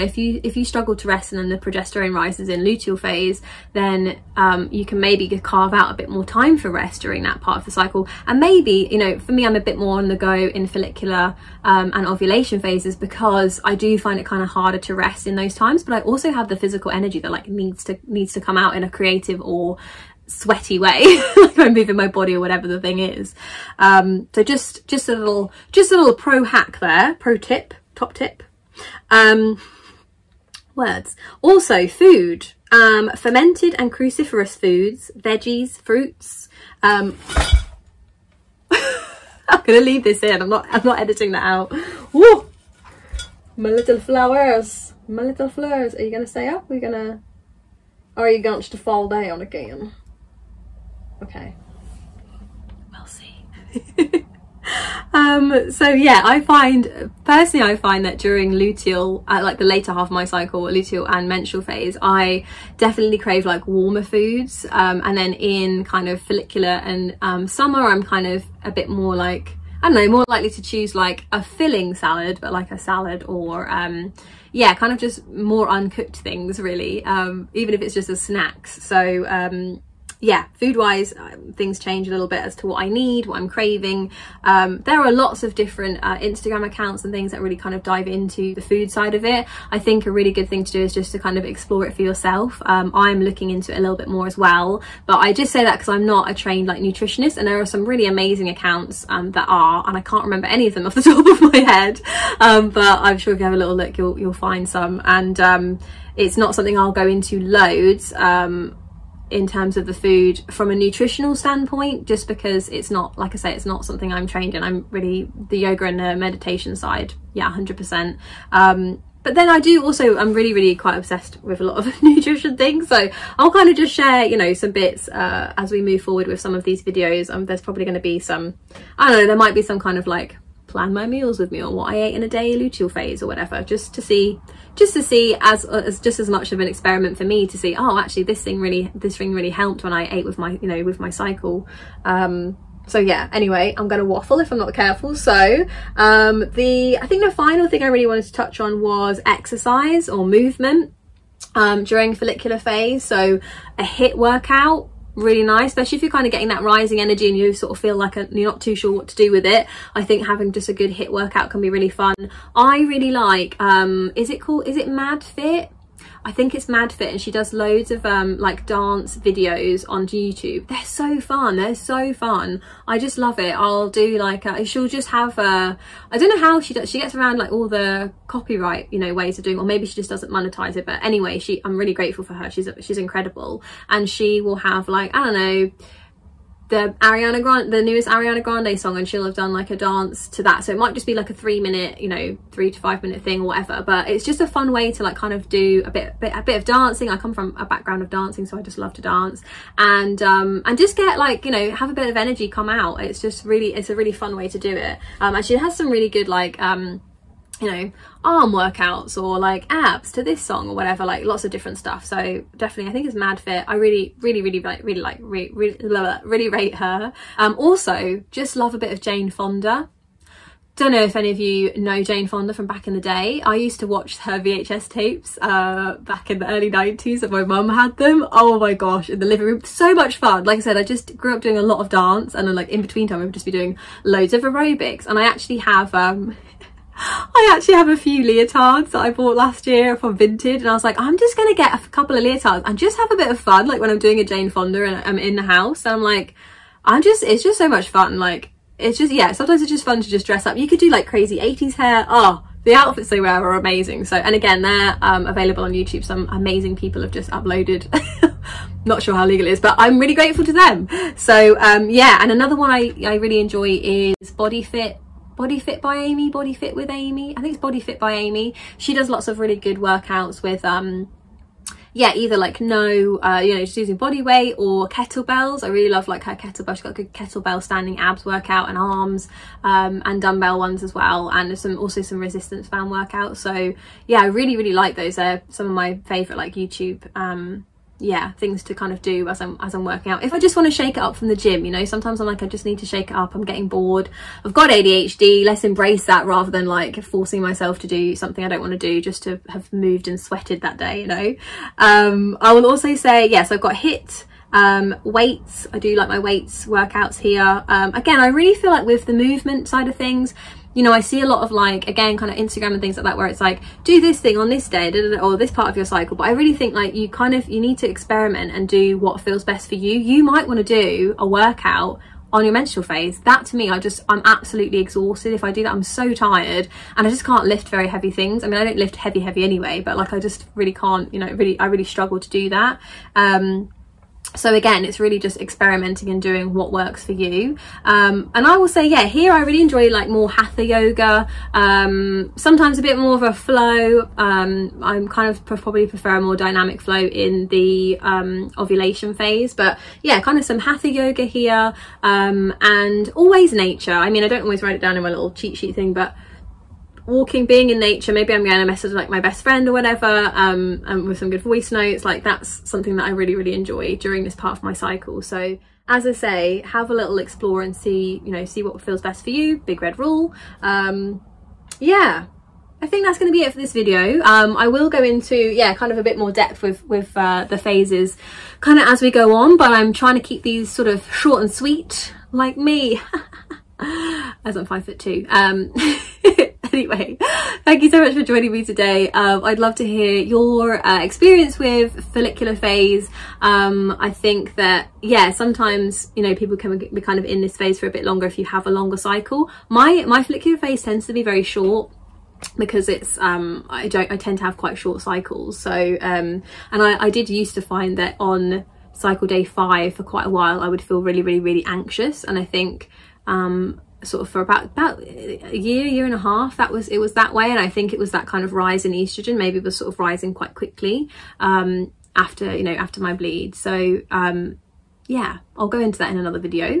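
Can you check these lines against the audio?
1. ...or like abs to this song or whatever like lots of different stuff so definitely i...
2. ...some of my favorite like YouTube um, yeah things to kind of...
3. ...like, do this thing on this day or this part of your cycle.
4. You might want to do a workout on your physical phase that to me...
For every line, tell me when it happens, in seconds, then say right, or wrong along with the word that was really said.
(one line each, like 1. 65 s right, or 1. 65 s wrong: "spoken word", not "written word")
1. 209 s right
2. 285 s right
3. 313 s right
4. 319 s wrong: "menstrual", not "physical".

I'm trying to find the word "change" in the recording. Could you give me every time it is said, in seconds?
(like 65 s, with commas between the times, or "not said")
81 s.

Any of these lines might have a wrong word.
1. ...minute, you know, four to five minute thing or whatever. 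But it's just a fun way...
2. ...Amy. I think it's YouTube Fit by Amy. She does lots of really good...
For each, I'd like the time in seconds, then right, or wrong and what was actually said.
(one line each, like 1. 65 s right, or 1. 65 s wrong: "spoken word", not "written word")
1. 191 s wrong: "three", not "four"
2. 266 s wrong: "Body", not "YouTube".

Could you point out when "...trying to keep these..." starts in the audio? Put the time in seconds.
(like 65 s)
379 s.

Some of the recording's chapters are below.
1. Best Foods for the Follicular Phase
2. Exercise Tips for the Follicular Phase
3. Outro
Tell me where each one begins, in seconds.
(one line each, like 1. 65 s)
1. 28 s
2. 146 s
3. 381 s.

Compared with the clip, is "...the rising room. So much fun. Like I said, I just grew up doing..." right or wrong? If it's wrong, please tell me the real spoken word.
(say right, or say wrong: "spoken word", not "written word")
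wrong: "living", not "rising".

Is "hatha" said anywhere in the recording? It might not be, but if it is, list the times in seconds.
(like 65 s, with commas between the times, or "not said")
340 s, 350 s.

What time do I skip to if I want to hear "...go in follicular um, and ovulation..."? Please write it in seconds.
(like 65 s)
10 s.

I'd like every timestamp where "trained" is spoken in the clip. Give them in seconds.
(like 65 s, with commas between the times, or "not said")
96 s, 114 s.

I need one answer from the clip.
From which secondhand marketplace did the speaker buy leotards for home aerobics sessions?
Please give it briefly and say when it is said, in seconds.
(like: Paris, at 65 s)
Vinted, at 240 s.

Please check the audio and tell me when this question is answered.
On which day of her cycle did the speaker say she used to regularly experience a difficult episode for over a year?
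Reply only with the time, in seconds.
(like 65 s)
408 s.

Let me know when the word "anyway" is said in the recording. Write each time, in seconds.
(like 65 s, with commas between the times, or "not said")
143 s, 181 s, 329 s, 386 s.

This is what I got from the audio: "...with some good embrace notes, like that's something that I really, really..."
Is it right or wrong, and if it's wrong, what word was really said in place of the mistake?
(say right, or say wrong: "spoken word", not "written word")
wrong: "voice", not "embrace".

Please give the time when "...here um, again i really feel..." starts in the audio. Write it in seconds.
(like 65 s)
307 s.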